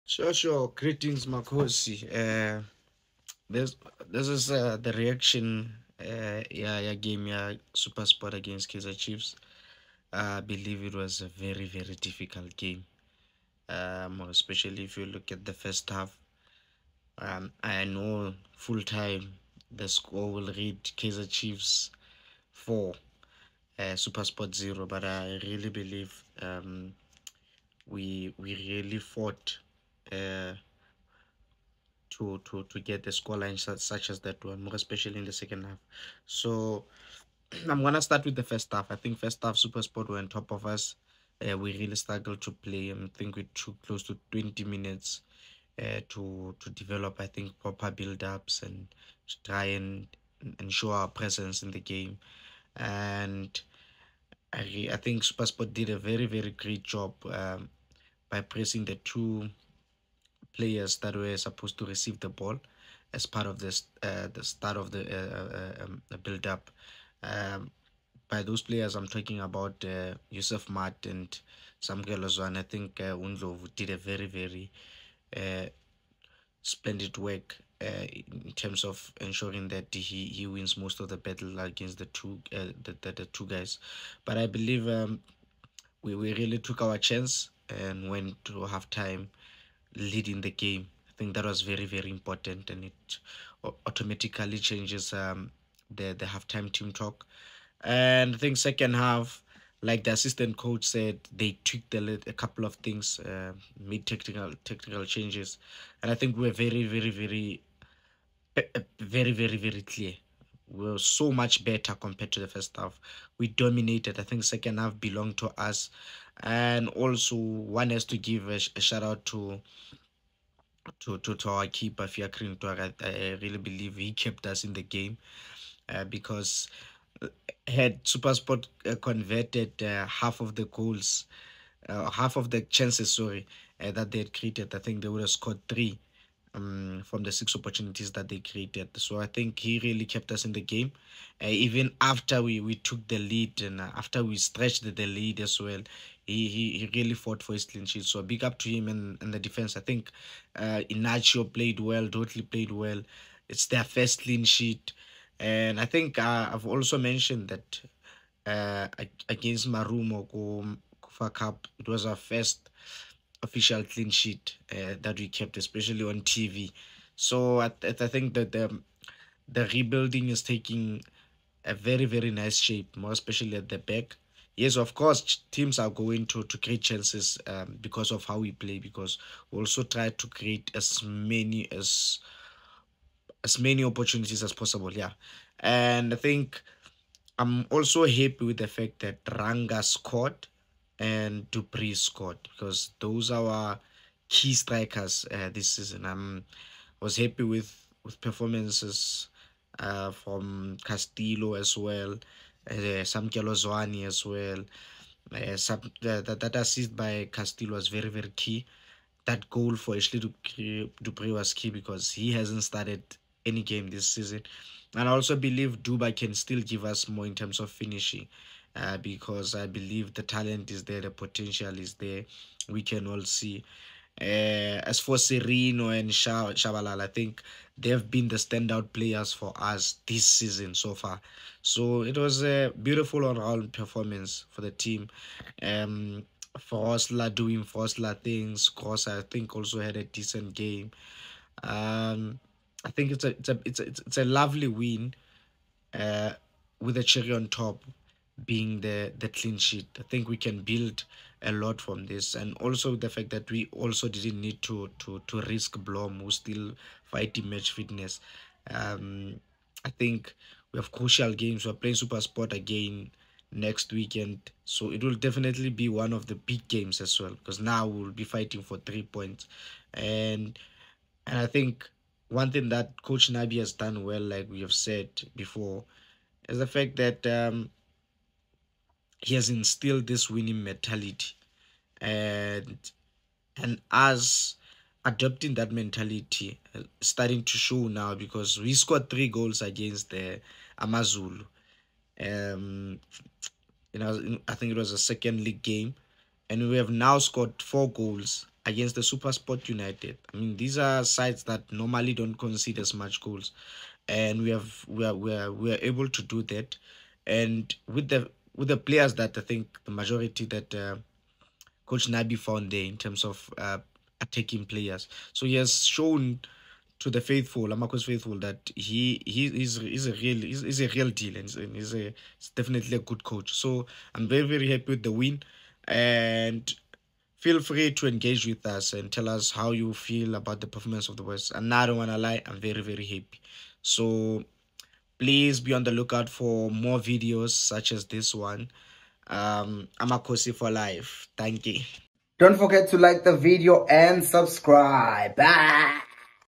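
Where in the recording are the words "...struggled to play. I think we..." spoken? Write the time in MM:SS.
00:41.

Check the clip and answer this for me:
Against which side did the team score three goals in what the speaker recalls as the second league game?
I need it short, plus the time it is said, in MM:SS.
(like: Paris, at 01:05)
AmaZulu, at 04:50.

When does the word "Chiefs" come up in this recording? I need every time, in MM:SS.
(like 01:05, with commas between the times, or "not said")
00:09, 00:21.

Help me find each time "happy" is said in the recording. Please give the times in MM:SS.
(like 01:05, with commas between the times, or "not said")
03:08, 03:17, 05:24, 05:33.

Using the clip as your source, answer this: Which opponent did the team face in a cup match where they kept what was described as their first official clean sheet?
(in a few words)
Marumo.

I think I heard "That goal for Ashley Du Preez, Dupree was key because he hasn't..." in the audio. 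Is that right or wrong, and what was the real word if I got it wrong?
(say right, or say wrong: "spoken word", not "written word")
right.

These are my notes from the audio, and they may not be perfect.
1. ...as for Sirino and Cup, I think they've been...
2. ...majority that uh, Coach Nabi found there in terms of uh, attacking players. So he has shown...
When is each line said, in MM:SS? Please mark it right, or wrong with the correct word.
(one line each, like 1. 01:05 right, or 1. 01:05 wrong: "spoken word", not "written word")
1. 03:44 wrong: "Shabalala", not "Cup"
2. 05:09 right.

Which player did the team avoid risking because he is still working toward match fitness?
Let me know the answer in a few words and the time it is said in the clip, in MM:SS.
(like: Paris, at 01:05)
Blom, at 04:15.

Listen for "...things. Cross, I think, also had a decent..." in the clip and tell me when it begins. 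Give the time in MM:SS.
03:58.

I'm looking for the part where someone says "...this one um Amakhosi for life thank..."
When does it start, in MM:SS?
05:38.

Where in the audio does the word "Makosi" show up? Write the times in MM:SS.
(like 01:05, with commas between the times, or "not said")
00:01.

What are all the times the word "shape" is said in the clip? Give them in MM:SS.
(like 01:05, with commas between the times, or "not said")
02:52.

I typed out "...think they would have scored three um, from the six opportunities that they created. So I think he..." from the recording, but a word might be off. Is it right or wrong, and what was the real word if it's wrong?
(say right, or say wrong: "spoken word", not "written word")
right.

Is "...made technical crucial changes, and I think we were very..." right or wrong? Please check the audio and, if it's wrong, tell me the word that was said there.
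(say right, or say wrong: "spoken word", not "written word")
wrong: "technical", not "crucial".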